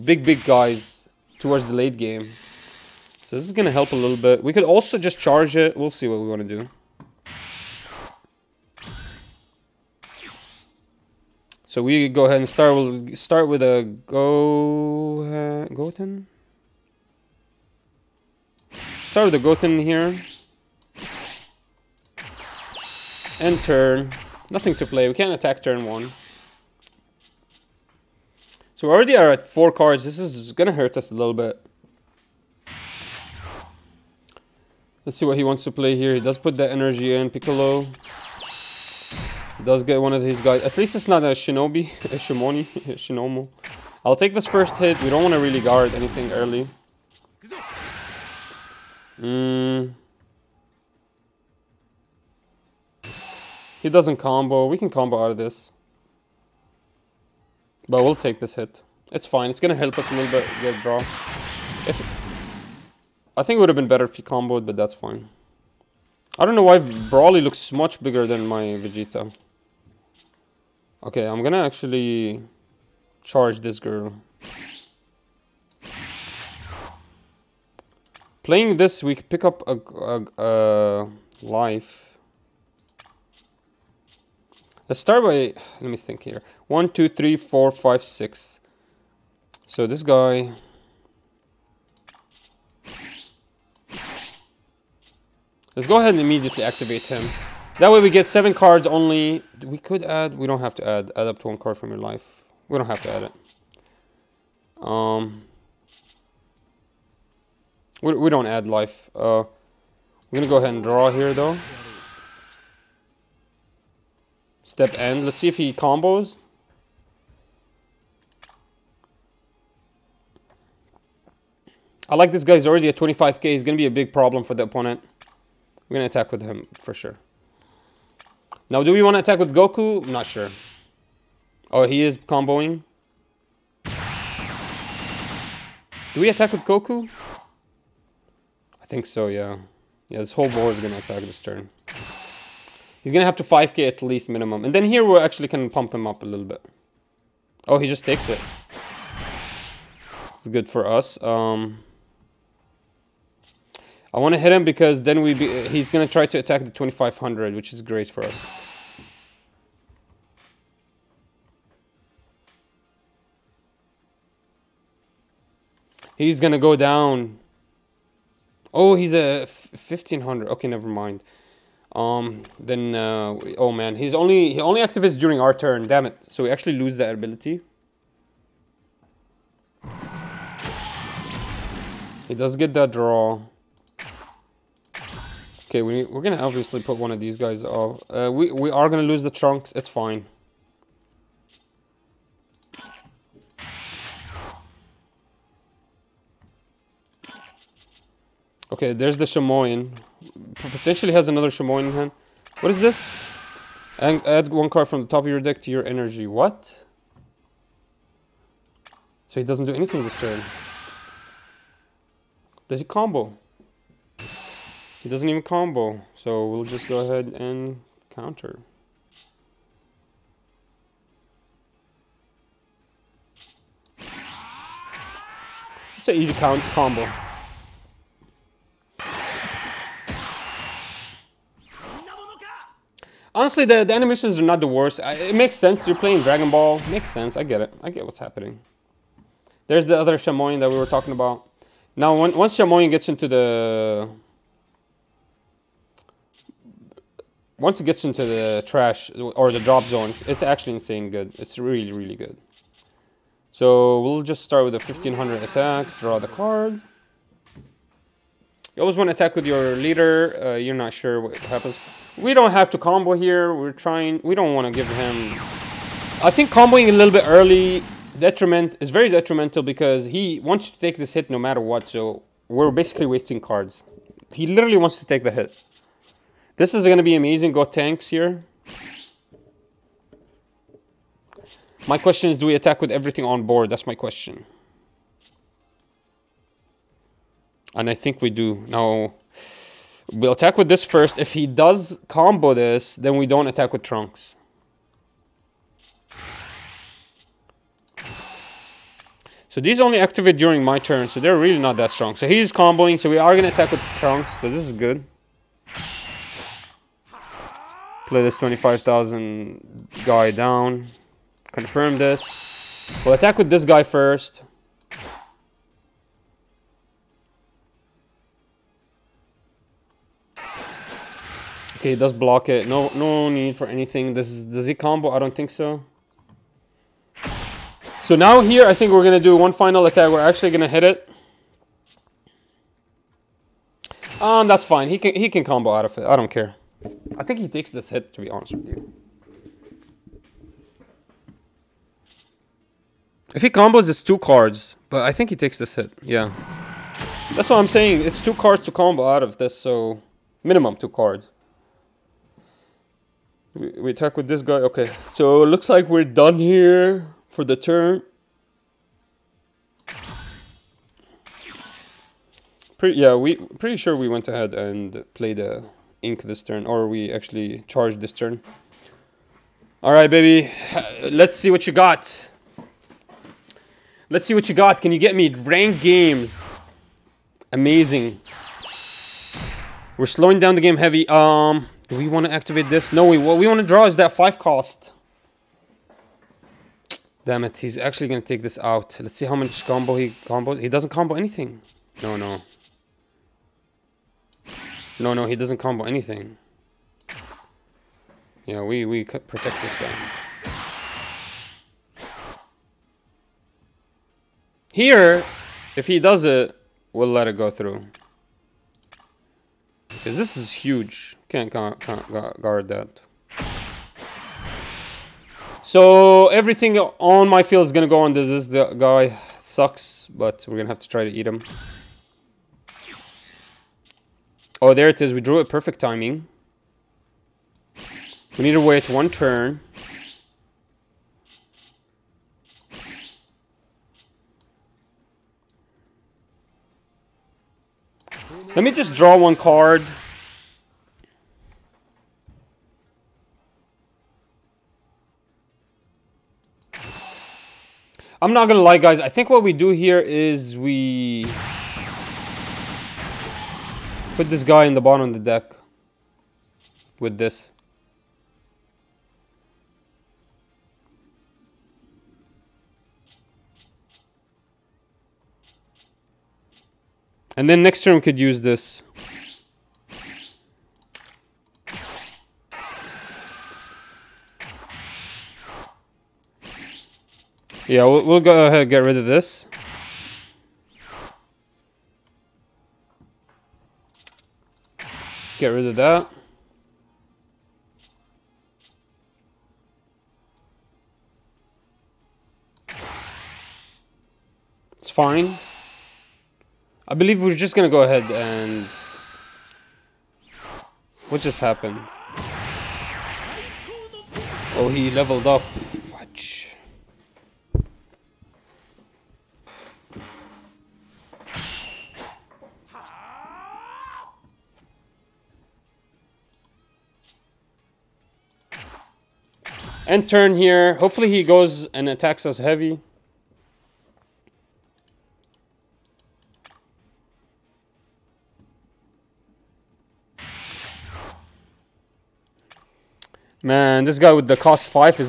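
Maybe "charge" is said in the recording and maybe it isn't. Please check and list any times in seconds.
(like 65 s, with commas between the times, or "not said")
5 s, 73 s, 367 s.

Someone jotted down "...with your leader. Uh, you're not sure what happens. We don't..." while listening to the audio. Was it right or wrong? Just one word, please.
right.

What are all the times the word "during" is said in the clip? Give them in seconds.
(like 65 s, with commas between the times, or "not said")
175 s, 300 s.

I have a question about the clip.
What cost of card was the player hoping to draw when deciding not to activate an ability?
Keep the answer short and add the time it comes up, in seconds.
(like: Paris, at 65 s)
5 cost, at 383 s.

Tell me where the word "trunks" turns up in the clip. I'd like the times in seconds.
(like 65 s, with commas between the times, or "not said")
189 s, 293 s, 303 s.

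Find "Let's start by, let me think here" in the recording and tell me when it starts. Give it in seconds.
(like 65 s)
84 s.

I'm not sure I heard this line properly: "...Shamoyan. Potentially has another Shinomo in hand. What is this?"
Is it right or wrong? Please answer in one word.
wrong.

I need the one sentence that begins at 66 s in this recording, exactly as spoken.
I don't know why Broly looks much bigger than my Vegeta.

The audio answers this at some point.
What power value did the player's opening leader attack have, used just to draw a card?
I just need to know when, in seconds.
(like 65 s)
254 s.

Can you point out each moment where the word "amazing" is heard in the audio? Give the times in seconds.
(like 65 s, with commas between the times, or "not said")
277 s, 377 s.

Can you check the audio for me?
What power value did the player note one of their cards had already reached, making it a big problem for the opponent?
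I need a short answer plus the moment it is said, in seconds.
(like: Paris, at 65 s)
25k, at 122 s.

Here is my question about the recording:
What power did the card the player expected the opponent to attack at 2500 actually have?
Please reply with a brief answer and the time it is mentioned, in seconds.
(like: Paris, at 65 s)
1500, at 168 s.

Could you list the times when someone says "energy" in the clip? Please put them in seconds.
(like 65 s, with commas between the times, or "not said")
36 s, 205 s.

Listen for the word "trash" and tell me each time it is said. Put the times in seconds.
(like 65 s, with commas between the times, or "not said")
248 s.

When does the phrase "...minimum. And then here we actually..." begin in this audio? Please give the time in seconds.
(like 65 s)
144 s.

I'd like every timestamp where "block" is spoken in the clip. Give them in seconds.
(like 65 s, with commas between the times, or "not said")
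322 s.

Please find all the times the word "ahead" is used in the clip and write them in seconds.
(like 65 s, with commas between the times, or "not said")
12 s, 95 s, 110 s, 216 s, 364 s, 478 s, 497 s.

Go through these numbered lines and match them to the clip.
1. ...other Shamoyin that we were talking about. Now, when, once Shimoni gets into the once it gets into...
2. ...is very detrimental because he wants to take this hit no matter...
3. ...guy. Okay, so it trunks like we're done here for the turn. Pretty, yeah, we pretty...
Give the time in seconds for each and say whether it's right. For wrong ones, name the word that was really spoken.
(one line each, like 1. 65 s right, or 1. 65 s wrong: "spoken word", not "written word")
1. 239 s wrong: "Shamoyin", not "Shimoni"
2. 268 s right
3. 354 s wrong: "looks", not "trunks".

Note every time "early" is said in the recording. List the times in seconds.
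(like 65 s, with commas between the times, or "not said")
46 s, 267 s.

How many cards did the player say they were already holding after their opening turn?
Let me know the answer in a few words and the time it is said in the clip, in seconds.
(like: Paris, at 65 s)
4, at 28 s.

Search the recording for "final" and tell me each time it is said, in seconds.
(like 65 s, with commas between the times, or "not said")
329 s.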